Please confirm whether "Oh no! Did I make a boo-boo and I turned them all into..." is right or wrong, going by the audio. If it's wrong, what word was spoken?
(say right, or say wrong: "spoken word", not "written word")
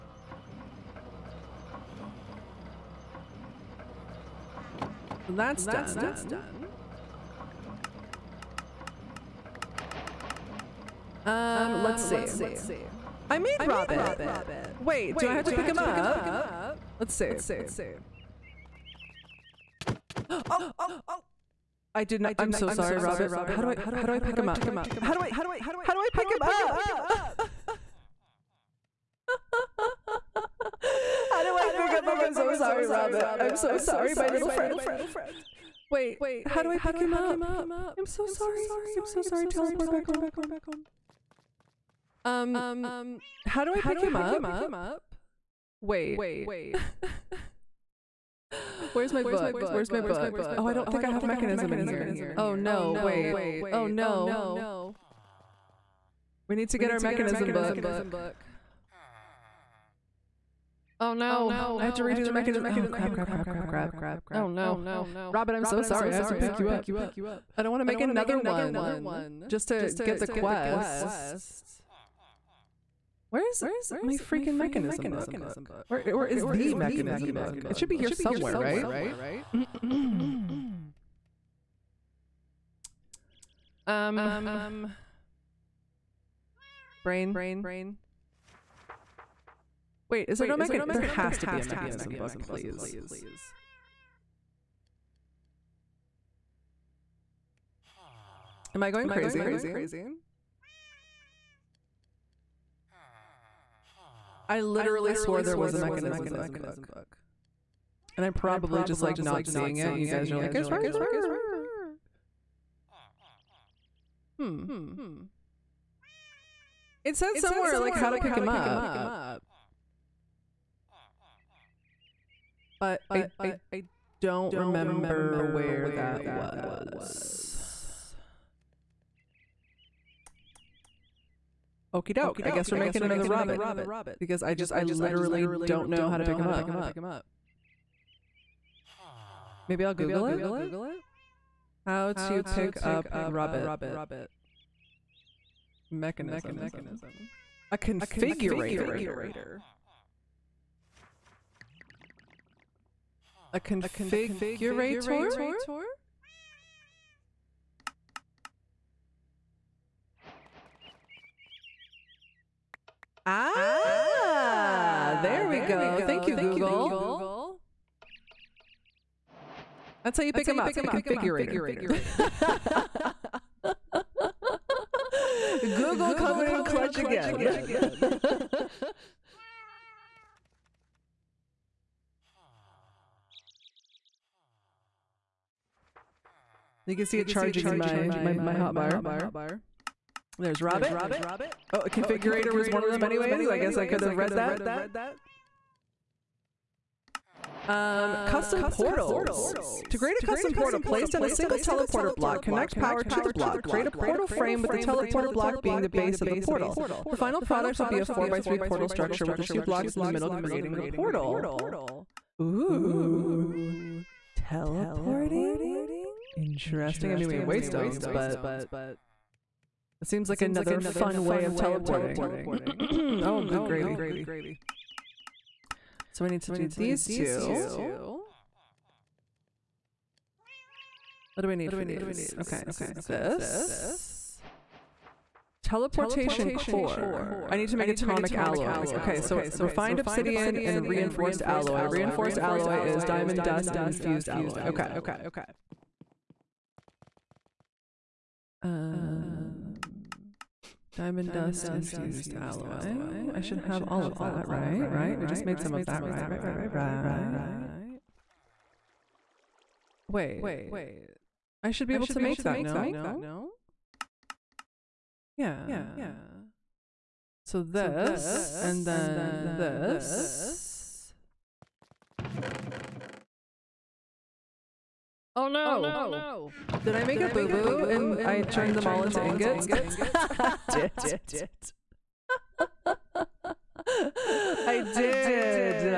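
right.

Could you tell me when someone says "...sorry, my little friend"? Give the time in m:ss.
0:33.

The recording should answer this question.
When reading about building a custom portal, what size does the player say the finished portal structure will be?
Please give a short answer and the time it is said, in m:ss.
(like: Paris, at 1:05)
4x3, at 3:28.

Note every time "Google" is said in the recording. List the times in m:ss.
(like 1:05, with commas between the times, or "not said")
2:19, 2:46, 2:55.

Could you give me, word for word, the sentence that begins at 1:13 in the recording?
Where is my freaking mechanism book?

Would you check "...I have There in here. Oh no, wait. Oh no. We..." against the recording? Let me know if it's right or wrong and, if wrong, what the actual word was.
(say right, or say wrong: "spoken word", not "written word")
wrong: "Mekanism", not "There".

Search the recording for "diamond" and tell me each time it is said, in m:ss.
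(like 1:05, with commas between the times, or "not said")
4:03, 4:10.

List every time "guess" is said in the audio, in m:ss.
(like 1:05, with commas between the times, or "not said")
2:12, 3:13.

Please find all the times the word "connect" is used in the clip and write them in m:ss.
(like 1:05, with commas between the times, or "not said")
3:22.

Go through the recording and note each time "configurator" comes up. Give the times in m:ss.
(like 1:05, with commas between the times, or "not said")
2:27, 2:33, 2:50, 3:11.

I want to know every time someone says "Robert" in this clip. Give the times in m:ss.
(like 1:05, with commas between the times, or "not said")
0:13, 0:22, 0:32, 3:10.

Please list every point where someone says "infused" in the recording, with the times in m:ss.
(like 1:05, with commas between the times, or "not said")
4:03, 4:11.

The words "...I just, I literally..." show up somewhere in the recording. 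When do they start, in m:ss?
2:14.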